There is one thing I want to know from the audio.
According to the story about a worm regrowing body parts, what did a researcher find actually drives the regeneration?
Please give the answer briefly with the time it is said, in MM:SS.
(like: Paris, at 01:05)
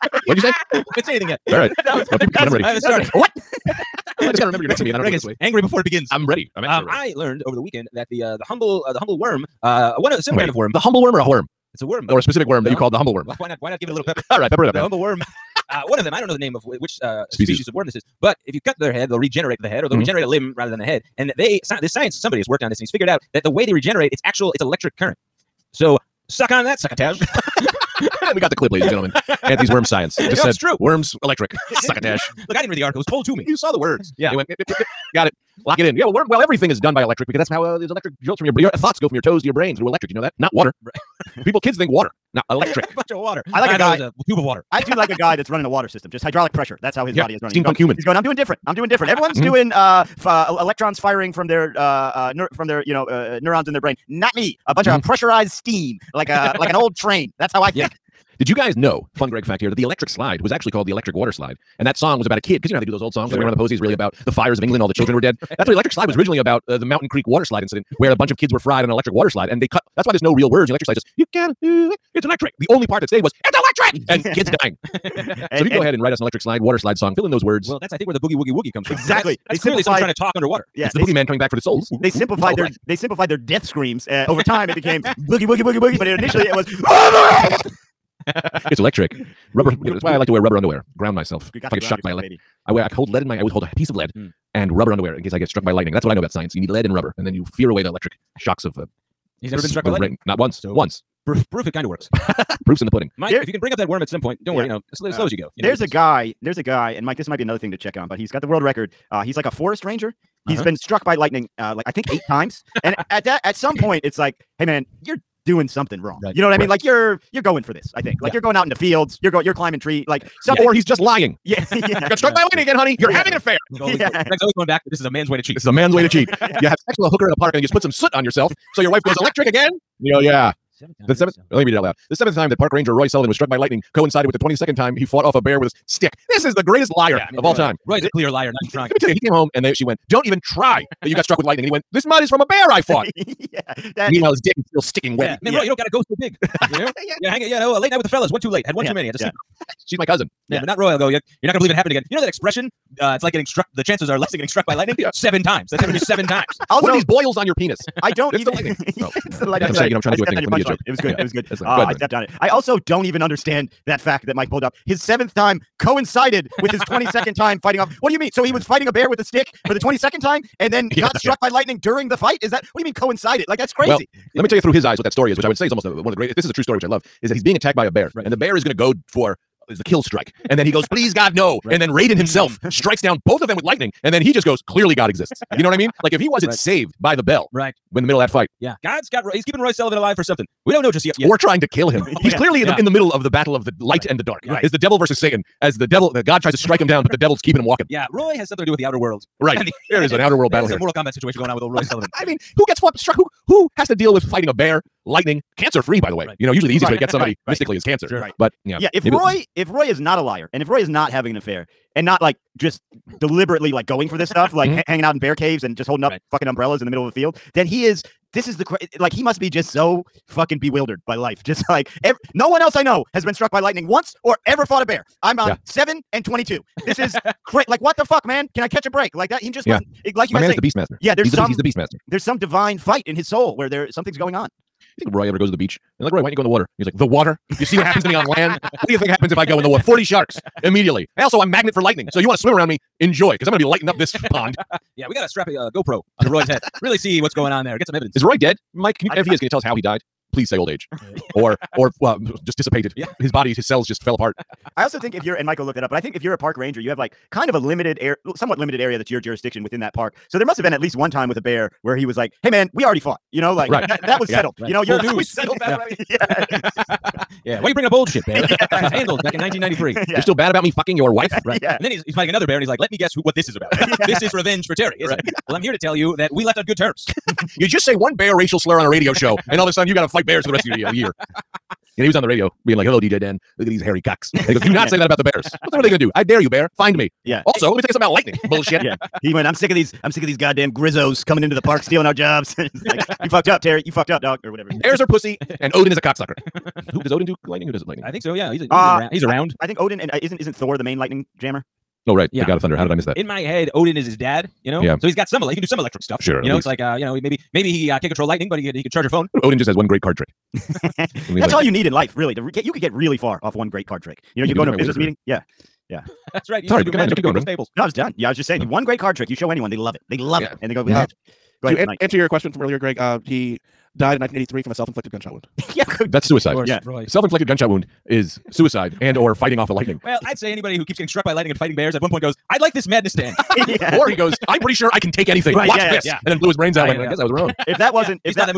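electric current, at 00:24.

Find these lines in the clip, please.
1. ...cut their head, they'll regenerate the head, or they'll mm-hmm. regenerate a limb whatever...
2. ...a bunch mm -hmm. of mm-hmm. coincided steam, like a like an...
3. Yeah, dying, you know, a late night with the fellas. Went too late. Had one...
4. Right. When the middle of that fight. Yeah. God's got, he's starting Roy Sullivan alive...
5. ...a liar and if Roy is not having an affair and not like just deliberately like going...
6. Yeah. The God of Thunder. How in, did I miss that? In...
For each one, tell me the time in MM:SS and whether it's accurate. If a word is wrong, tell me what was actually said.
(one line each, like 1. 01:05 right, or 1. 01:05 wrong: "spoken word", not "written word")
1. 00:18 wrong: "rather", not "whatever"
2. 00:54 wrong: "pressurized", not "coincided"
3. 02:27 wrong: "hanging", not "dying"
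4. 03:07 wrong: "keeping", not "starting"
5. 03:30 right
6. 05:02 right.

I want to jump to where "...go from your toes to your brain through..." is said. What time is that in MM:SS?
00:38.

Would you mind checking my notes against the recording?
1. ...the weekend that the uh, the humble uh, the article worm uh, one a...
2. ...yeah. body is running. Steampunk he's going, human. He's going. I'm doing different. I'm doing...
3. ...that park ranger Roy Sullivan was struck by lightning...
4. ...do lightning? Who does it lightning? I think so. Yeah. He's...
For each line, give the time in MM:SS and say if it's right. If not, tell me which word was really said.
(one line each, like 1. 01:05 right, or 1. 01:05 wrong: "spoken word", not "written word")
1. 00:07 wrong: "humble", not "article"
2. 00:47 right
3. 02:12 right
4. 04:57 right.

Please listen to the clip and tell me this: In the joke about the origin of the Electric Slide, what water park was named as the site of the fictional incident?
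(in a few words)
Mountain Creek.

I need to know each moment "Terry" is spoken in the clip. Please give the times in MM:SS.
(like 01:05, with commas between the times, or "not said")
04:34, 04:53.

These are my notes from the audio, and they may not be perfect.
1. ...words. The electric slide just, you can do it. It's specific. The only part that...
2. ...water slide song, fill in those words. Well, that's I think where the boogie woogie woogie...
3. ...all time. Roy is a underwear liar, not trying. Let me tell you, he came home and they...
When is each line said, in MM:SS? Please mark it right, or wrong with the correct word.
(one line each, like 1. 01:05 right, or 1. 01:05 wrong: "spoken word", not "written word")
1. 01:10 wrong: "electric", not "specific"
2. 01:16 right
3. 02:17 wrong: "clear", not "underwear".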